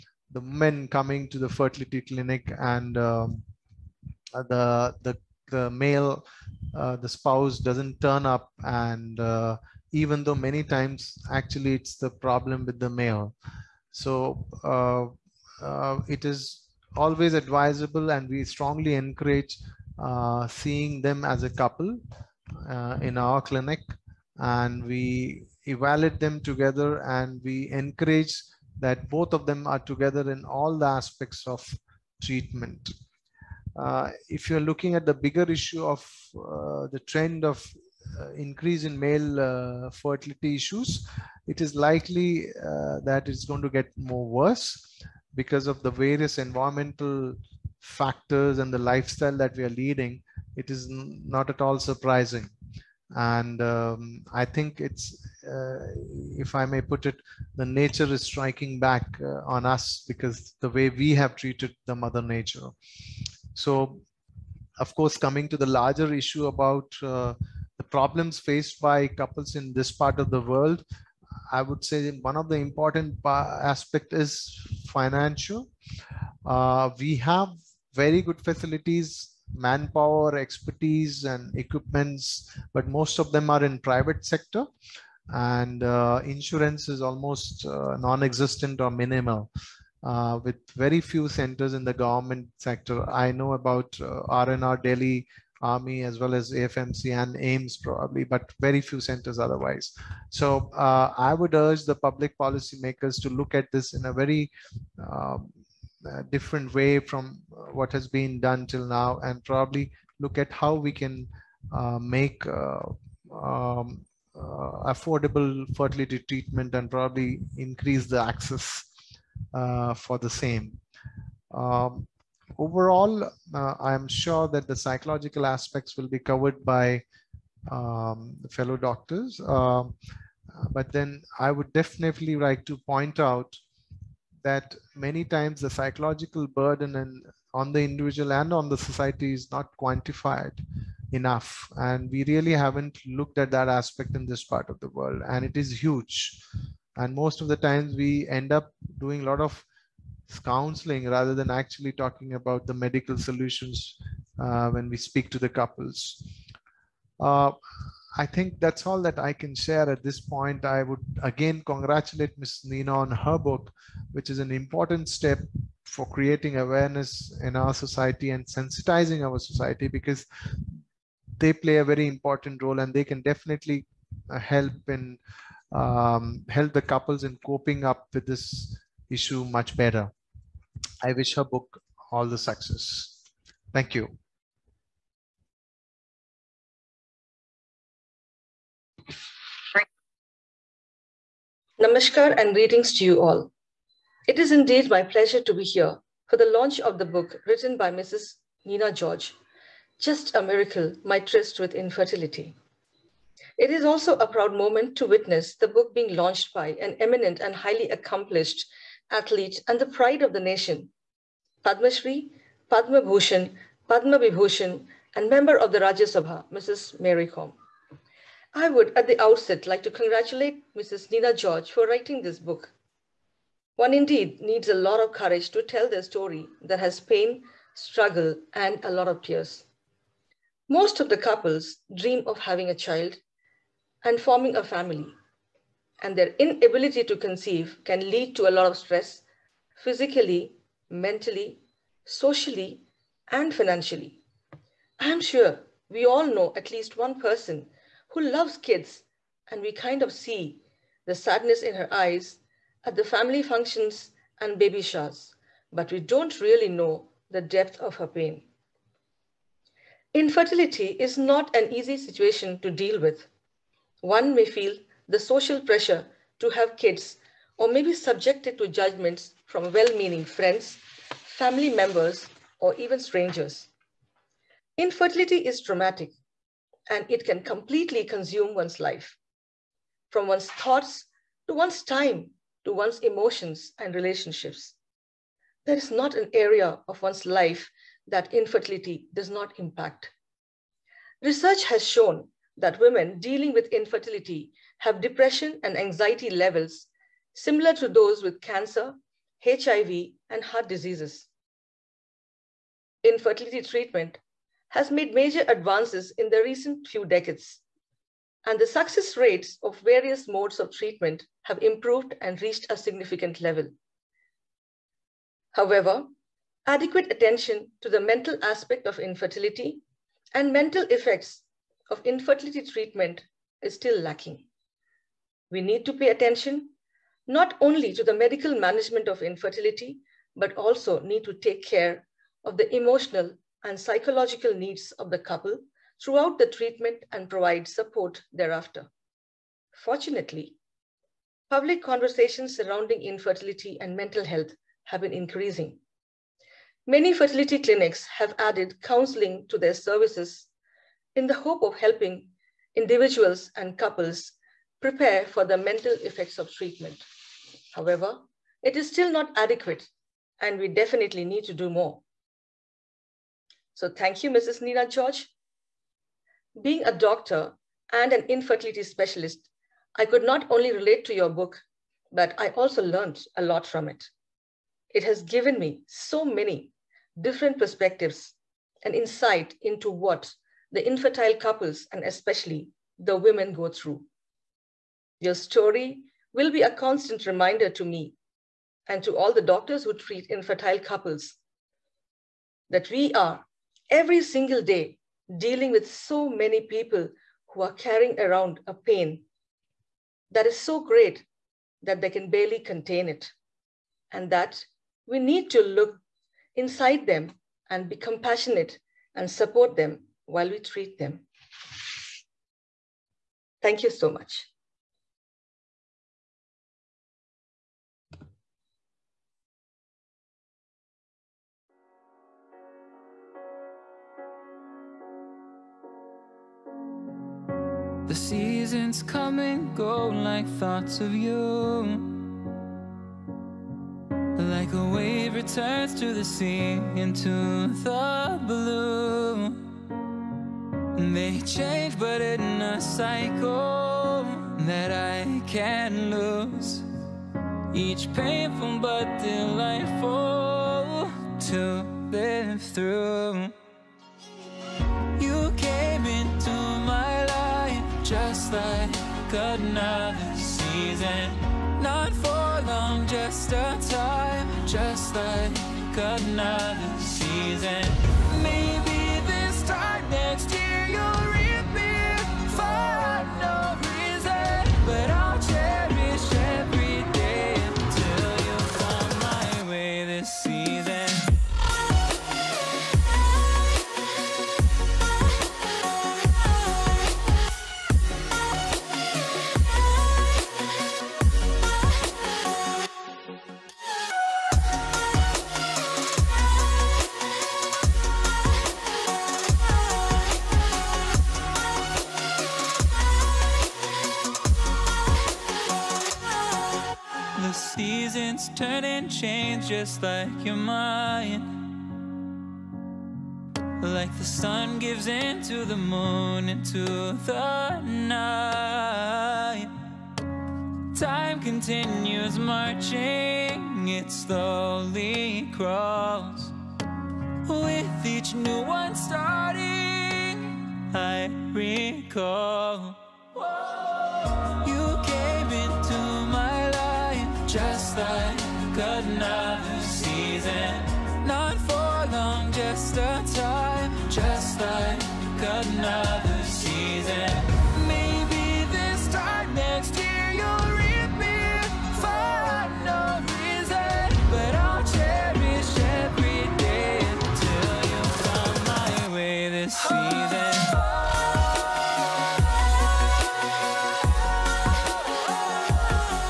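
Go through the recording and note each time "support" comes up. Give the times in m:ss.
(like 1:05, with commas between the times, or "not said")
5:37, 6:49.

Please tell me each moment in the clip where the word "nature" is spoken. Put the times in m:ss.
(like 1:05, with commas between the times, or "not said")
0:57, 1:02.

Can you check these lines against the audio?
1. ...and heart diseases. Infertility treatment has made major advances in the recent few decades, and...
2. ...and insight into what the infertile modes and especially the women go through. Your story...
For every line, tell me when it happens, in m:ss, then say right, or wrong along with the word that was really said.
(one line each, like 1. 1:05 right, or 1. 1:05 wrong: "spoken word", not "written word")
1. 5:00 right
2. 6:18 wrong: "couples", not "modes".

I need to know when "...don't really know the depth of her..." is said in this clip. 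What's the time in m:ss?
4:15.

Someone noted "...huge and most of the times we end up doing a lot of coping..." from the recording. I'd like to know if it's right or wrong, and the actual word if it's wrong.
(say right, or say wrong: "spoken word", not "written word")
wrong: "counseling", not "coping".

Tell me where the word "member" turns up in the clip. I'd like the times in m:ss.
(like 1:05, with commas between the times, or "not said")
3:35, 4:31.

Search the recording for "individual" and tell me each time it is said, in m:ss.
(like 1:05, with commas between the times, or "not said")
2:17, 5:52.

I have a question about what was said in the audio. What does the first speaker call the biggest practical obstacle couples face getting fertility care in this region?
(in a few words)
Financial.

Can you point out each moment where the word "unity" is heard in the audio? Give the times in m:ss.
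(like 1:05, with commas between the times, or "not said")
not said.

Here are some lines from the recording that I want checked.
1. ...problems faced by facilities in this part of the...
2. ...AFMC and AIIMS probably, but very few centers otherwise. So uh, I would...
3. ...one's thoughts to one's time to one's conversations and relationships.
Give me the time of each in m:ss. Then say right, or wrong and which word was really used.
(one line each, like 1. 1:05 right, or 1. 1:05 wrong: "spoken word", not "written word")
1. 1:07 wrong: "couples", not "facilities"
2. 1:36 right
3. 4:40 wrong: "emotions", not "conversations".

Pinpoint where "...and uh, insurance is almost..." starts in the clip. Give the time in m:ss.
1:25.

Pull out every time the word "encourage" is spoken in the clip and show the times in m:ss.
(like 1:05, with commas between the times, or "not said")
0:18, 0:27.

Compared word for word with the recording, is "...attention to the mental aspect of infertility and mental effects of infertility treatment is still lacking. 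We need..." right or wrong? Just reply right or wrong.
right.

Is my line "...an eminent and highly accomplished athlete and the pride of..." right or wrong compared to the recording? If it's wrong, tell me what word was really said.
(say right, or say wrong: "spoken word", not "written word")
right.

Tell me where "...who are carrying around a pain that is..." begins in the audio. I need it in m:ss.
6:37.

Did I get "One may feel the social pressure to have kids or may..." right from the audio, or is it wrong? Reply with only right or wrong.
right.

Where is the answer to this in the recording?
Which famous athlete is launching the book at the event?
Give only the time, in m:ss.
3:36.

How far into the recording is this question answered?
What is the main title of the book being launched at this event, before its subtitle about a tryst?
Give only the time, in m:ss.
3:20.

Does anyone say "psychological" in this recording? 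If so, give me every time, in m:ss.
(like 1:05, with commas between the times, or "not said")
2:04, 2:15, 5:33.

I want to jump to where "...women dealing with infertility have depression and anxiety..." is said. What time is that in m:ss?
4:52.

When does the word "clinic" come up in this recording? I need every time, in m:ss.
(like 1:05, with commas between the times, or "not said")
0:02, 0:23, 5:47.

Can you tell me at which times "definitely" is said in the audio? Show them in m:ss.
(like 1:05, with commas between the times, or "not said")
2:11, 2:53, 6:00.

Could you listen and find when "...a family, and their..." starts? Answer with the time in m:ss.
3:54.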